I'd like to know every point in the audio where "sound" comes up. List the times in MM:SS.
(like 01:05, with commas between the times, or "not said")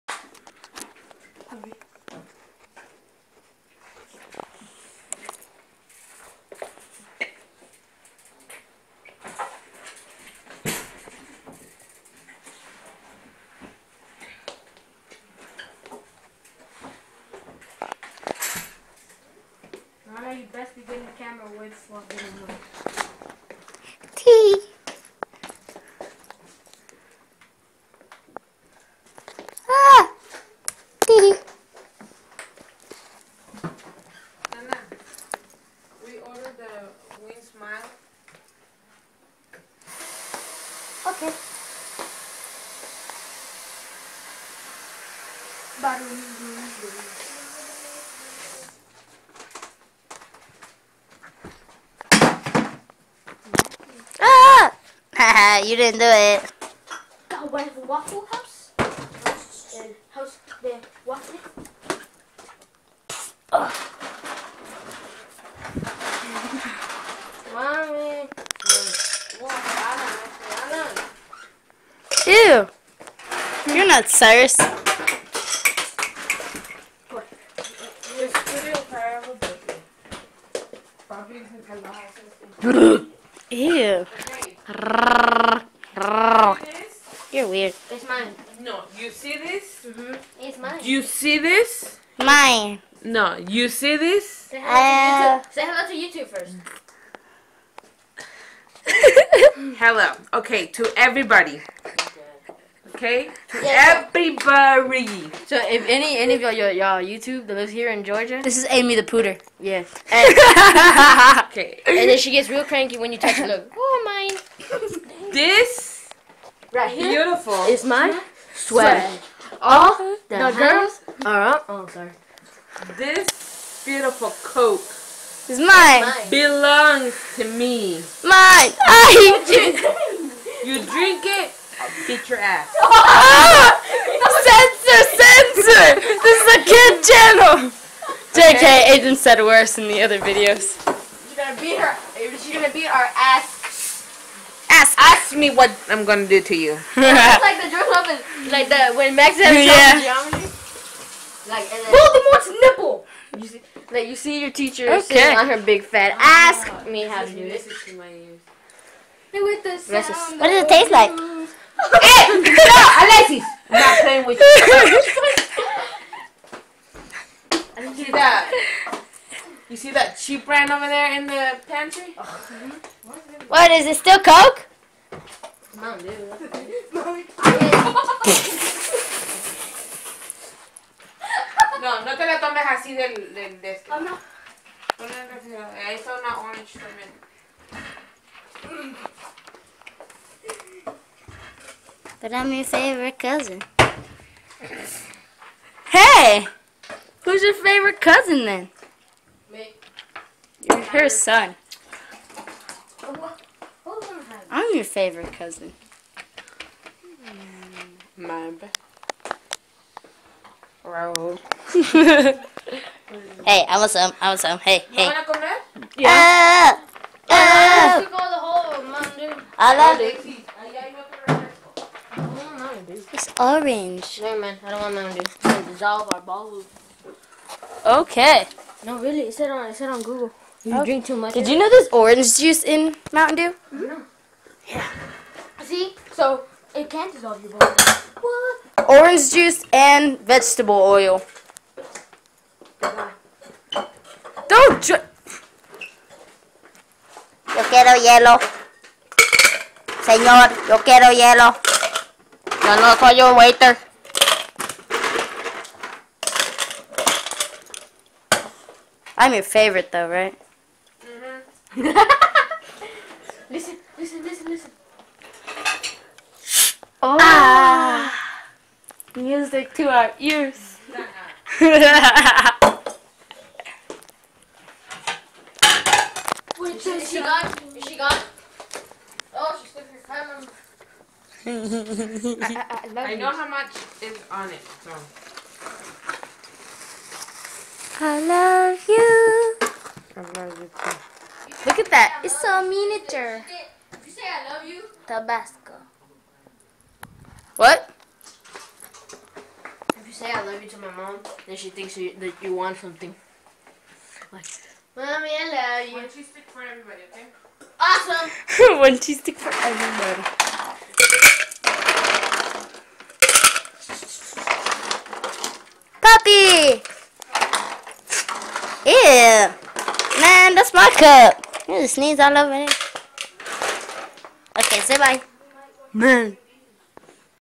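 02:39.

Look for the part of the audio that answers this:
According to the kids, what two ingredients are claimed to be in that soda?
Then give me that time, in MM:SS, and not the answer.
03:58.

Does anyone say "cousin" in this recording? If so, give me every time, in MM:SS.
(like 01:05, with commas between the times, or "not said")
03:13, 03:17, 03:25.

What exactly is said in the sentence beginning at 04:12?
Y'all know I call your waiter.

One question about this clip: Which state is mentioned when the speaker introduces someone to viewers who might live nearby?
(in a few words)
Georgia.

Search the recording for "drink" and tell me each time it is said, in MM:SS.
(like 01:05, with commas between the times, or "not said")
02:10, 03:50, 04:04.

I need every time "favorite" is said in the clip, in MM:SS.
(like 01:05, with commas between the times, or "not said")
03:12, 03:17, 03:24, 04:19.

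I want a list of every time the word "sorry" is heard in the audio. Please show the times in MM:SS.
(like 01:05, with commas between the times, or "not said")
00:01, 02:01.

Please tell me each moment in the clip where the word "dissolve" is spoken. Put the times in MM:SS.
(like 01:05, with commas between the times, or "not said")
03:45, 03:57.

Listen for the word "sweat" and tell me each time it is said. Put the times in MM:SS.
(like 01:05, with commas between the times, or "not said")
01:58.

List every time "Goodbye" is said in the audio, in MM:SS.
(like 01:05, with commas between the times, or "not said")
04:02.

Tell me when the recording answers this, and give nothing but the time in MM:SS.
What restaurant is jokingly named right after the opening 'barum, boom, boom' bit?
00:57.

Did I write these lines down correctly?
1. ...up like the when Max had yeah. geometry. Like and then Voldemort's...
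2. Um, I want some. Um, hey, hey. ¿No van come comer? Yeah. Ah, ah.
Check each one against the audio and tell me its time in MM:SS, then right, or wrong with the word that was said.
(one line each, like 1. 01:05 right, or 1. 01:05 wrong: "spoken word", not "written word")
1. 02:27 right
2. 03:34 right.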